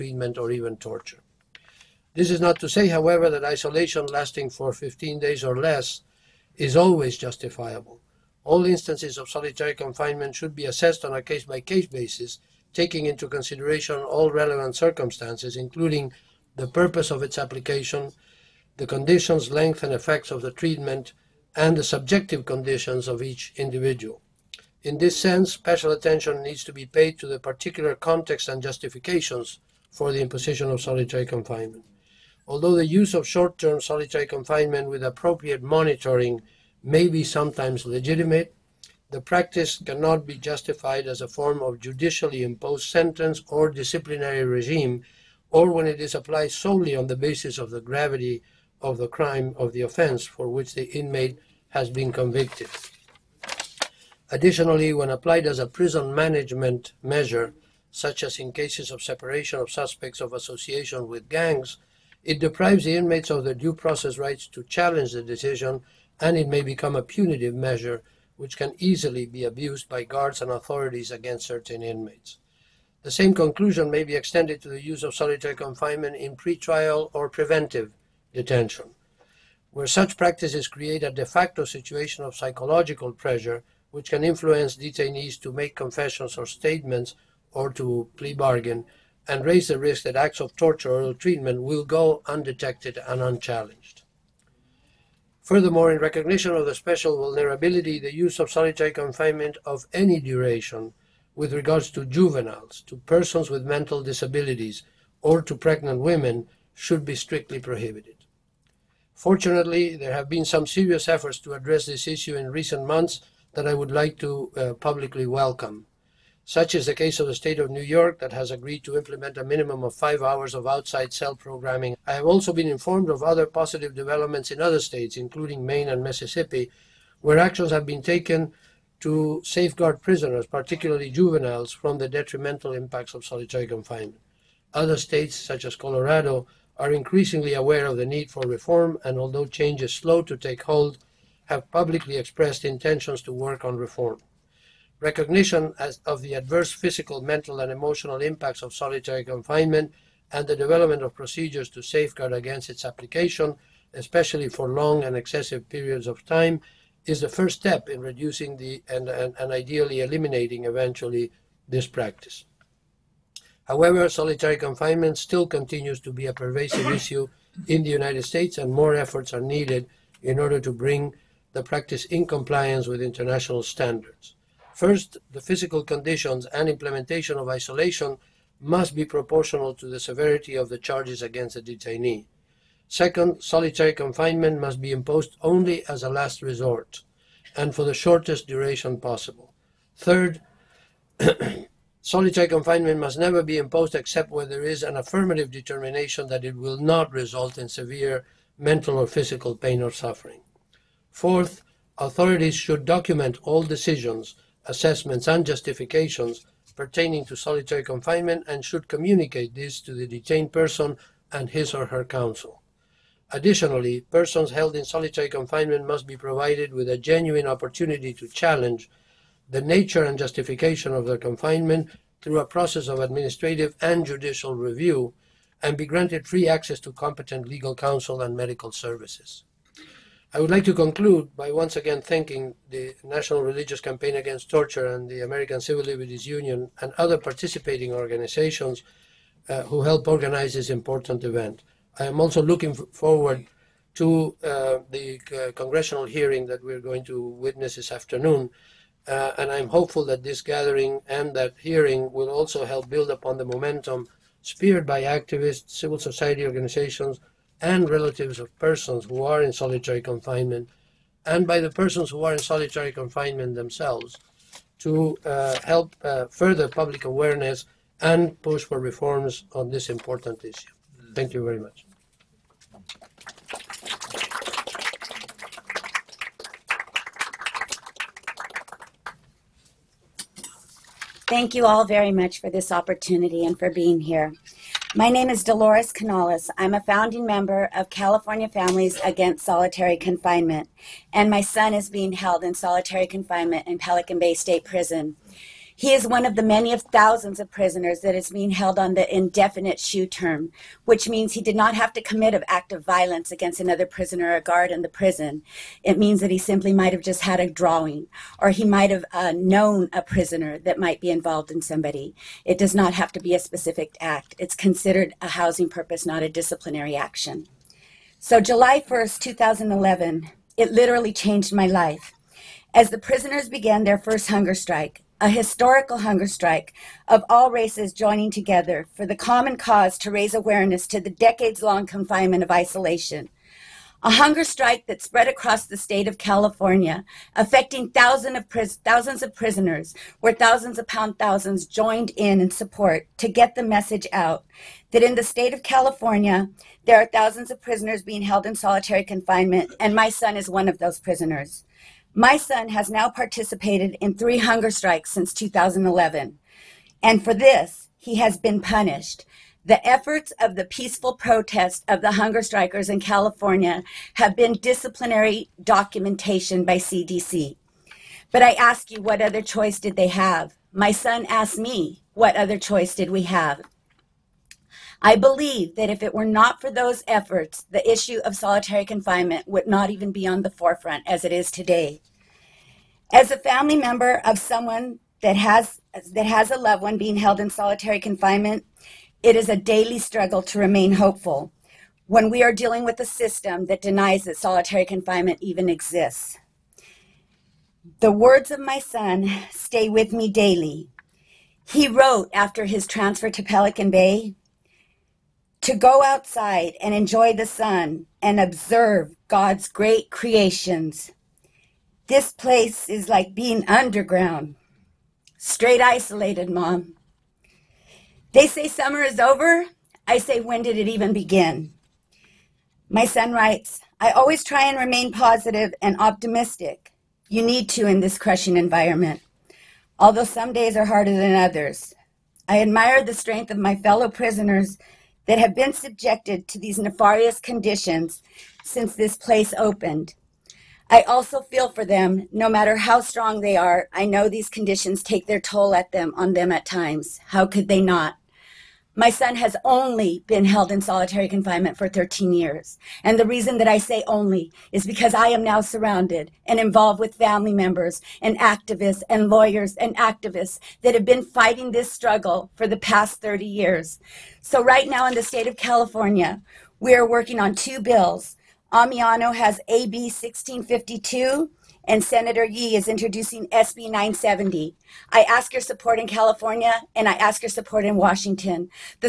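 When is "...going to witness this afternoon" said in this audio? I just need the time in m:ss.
4:06.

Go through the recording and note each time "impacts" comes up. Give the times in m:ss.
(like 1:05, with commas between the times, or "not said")
2:12, 2:28.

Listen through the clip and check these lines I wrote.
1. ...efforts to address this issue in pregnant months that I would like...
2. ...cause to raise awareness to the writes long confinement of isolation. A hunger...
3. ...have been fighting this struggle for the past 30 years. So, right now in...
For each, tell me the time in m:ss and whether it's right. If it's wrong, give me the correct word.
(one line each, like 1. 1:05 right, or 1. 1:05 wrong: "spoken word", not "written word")
1. 1:51 wrong: "recent", not "pregnant"
2. 5:29 wrong: "decades", not "writes"
3. 7:40 right.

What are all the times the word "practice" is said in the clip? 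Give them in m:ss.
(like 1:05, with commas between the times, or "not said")
0:39, 1:20, 2:41, 2:51.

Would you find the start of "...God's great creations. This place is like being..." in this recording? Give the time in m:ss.
6:49.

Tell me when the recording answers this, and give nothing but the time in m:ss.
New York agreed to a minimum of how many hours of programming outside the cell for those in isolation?
1:59.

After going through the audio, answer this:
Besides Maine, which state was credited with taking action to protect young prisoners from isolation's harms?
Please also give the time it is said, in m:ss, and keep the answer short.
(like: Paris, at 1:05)
Mississippi, at 2:06.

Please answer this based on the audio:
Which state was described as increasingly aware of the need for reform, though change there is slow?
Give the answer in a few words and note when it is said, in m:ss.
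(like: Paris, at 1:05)
Colorado, at 2:15.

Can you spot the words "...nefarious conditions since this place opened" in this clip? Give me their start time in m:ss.
7:16.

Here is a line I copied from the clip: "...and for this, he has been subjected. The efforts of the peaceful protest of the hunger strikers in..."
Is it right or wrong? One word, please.
wrong.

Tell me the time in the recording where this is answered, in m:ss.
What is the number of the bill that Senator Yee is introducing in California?
7:53.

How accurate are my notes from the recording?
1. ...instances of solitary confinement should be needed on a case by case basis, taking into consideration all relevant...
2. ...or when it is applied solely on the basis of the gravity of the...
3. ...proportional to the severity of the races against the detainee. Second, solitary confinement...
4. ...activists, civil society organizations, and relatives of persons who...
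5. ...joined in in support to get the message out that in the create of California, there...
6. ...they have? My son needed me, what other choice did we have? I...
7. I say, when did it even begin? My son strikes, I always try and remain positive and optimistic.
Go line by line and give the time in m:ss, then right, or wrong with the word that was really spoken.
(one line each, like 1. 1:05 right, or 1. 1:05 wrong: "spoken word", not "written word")
1. 0:08 wrong: "assessed", not "needed"
2. 0:45 right
3. 2:59 wrong: "charges", not "races"
4. 4:15 right
5. 5:41 wrong: "state", not "create"
6. 6:09 wrong: "asked", not "needed"
7. 7:00 wrong: "writes", not "strikes".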